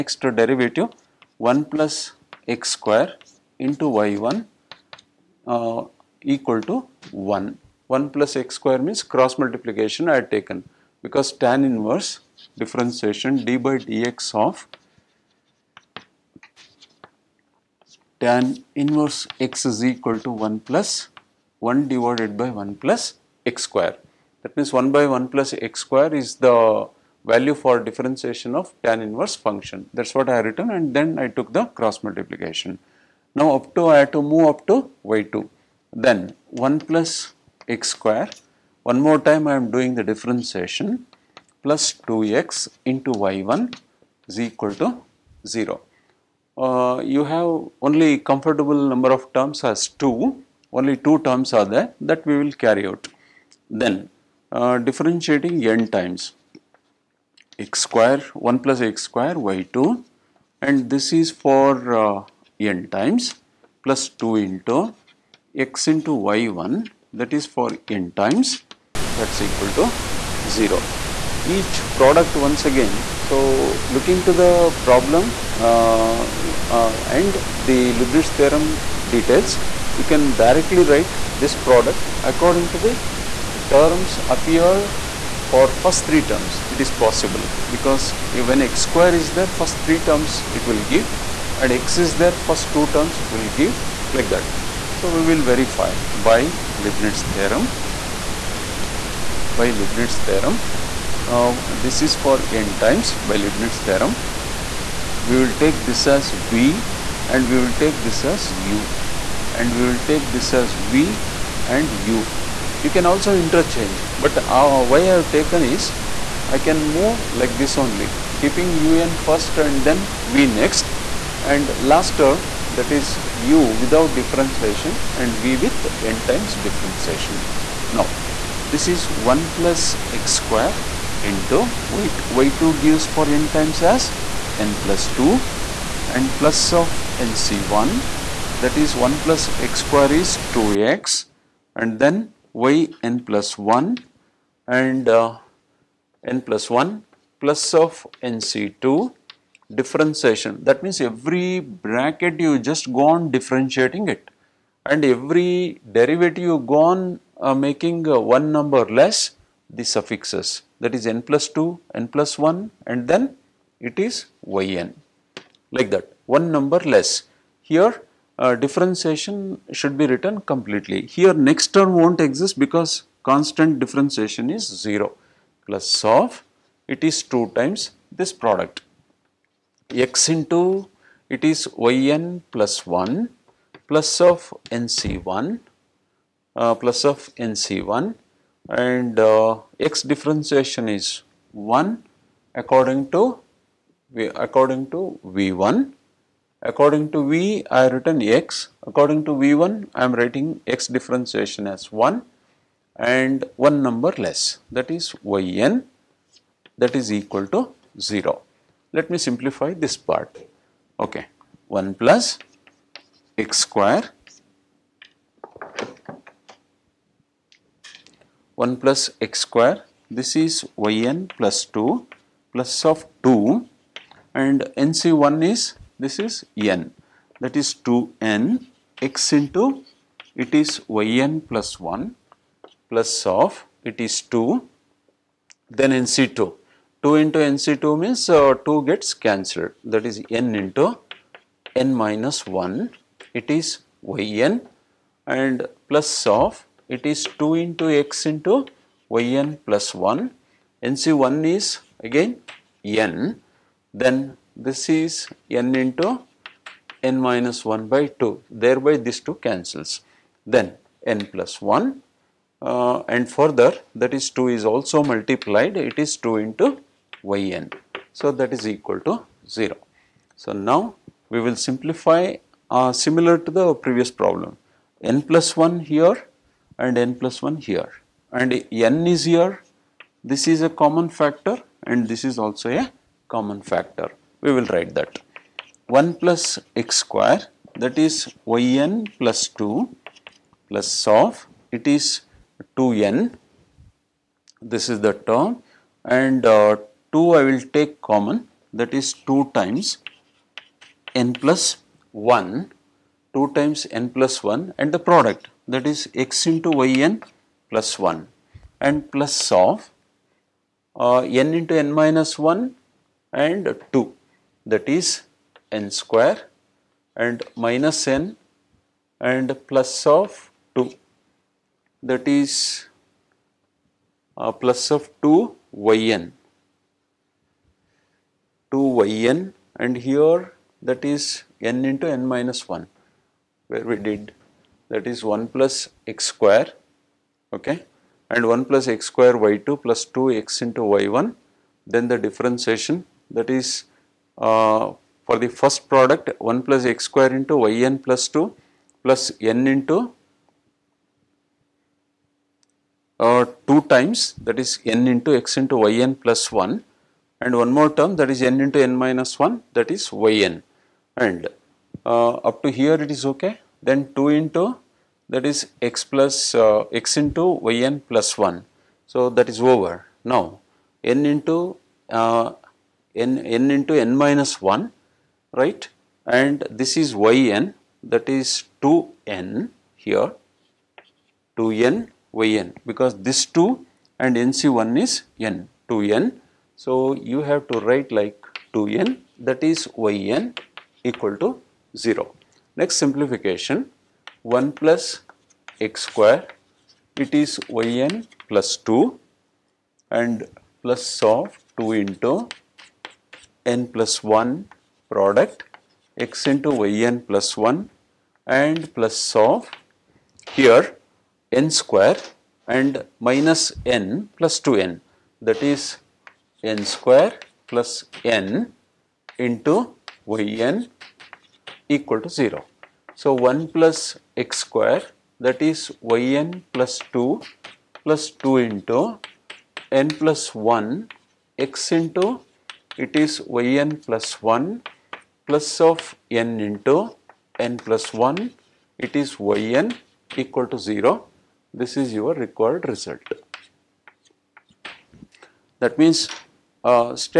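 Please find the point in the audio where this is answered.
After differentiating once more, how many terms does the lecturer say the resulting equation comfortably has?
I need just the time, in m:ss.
0:50.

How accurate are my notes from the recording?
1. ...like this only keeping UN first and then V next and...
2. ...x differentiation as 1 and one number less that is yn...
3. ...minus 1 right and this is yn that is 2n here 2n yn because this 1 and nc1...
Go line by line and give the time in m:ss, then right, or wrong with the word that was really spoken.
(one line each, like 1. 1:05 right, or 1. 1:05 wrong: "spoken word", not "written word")
1. 1:57 right
2. 3:20 right
3. 6:14 wrong: "2", not "1".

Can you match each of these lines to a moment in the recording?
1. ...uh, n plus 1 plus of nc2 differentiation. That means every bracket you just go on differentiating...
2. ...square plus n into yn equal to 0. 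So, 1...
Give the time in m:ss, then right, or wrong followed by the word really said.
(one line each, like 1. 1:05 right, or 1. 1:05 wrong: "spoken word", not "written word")
1. 2:25 right
2. 6:56 right.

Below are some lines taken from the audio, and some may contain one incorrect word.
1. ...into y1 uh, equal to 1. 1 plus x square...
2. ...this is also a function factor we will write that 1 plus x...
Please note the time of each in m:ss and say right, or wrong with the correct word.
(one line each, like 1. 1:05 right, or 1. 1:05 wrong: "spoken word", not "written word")
1. 0:03 right
2. 4:42 wrong: "common", not "function".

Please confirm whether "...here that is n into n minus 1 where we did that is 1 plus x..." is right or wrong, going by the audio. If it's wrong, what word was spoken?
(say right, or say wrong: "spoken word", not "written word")
right.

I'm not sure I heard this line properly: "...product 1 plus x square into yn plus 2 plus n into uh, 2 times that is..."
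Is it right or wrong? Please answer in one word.
right.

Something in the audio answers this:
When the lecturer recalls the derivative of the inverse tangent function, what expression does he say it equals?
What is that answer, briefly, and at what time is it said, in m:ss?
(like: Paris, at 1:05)
1 by 1 plus x square, at 0:24.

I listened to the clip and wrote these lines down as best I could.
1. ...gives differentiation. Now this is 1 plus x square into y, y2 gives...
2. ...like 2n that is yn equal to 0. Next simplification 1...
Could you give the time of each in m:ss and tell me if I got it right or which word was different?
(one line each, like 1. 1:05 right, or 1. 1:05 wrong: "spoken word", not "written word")
1. 2:06 wrong: "times", not "gives"
2. 6:28 right.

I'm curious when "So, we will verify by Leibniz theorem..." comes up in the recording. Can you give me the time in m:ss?
1:34.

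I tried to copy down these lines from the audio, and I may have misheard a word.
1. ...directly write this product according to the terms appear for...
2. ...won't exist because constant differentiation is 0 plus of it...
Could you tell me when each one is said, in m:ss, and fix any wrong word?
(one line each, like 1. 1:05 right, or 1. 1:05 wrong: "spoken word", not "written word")
1. 1:20 right
2. 2:51 right.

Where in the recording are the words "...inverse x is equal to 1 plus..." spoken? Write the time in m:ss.
0:18.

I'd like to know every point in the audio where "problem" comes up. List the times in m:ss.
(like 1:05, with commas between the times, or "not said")
1:14, 4:34.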